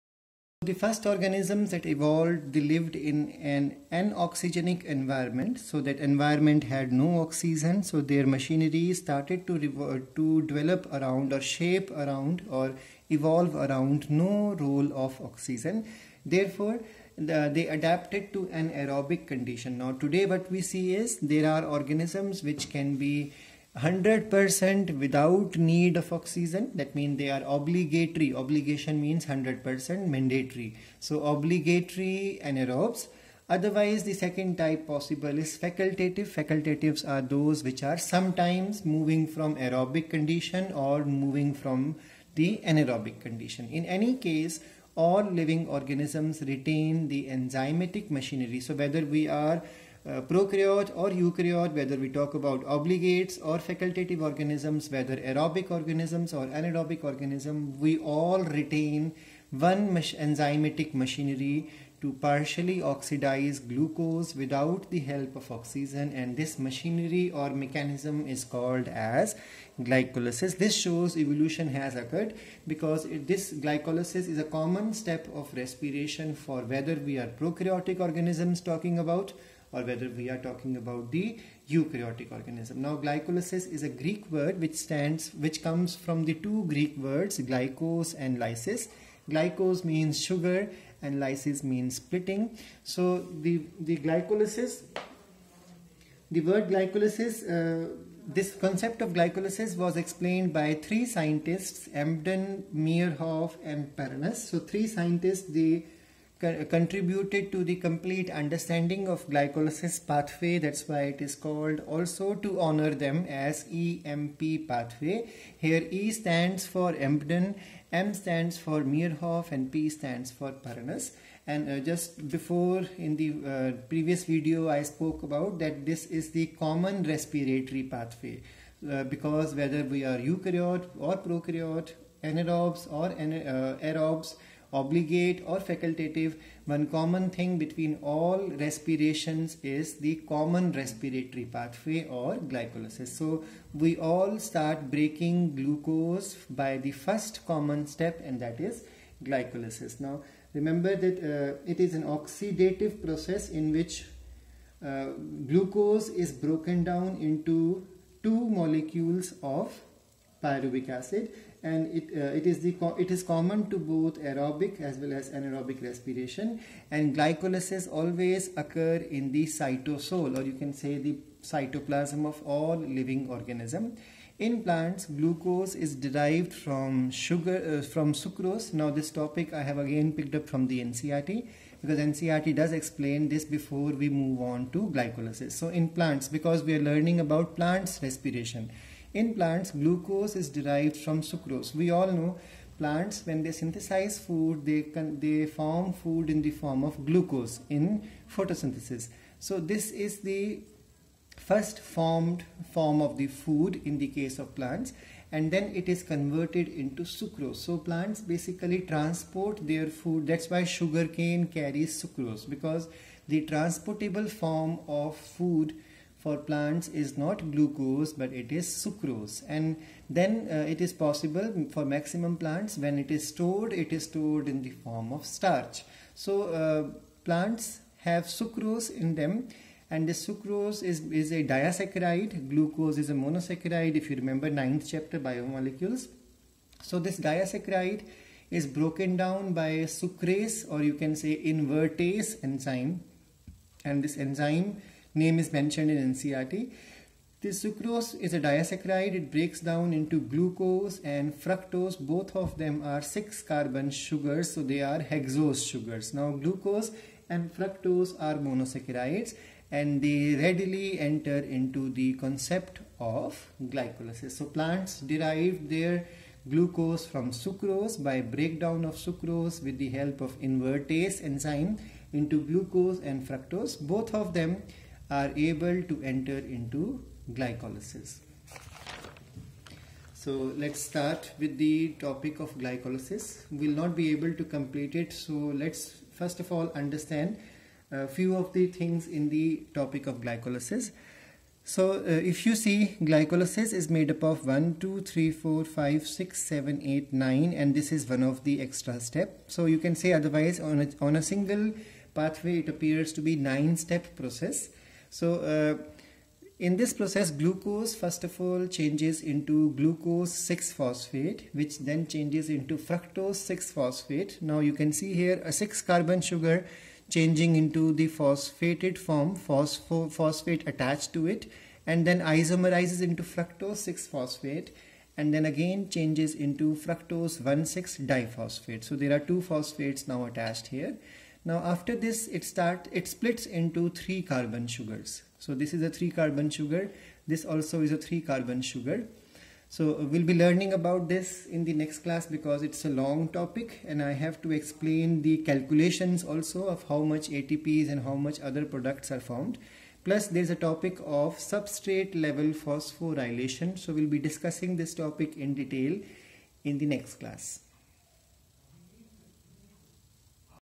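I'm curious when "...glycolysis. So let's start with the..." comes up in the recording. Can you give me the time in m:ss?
4:37.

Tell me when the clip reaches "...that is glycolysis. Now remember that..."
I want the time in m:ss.
2:28.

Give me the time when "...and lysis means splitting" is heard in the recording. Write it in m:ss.
1:31.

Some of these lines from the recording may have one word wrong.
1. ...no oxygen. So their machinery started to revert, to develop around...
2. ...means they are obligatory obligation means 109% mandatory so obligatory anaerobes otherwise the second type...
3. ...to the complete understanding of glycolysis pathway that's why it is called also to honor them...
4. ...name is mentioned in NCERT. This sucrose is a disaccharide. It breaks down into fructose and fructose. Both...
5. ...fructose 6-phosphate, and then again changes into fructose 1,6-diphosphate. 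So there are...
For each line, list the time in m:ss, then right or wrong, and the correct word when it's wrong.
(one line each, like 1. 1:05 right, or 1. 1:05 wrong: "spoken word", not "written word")
1. 0:06 right
2. 0:26 wrong: "100", not "109"
3. 1:47 right
4. 4:05 wrong: "glucose", not "fructose"
5. 5:23 right.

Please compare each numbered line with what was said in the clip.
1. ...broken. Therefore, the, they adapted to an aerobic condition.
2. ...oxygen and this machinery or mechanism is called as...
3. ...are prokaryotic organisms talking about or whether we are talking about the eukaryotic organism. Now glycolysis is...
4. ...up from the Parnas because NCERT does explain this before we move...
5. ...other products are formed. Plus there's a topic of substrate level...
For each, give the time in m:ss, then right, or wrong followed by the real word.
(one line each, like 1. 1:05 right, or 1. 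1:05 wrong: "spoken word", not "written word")
1. 0:15 wrong: "oxygen", not "broken"
2. 1:05 right
3. 1:17 right
4. 3:00 wrong: "NCERT", not "Parnas"
5. 5:48 right.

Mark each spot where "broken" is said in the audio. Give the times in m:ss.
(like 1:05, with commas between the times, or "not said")
2:36, 3:58.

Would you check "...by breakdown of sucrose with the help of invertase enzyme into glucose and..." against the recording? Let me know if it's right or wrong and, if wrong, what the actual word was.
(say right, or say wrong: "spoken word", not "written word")
right.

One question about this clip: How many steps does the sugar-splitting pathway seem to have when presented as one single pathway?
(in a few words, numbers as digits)
9.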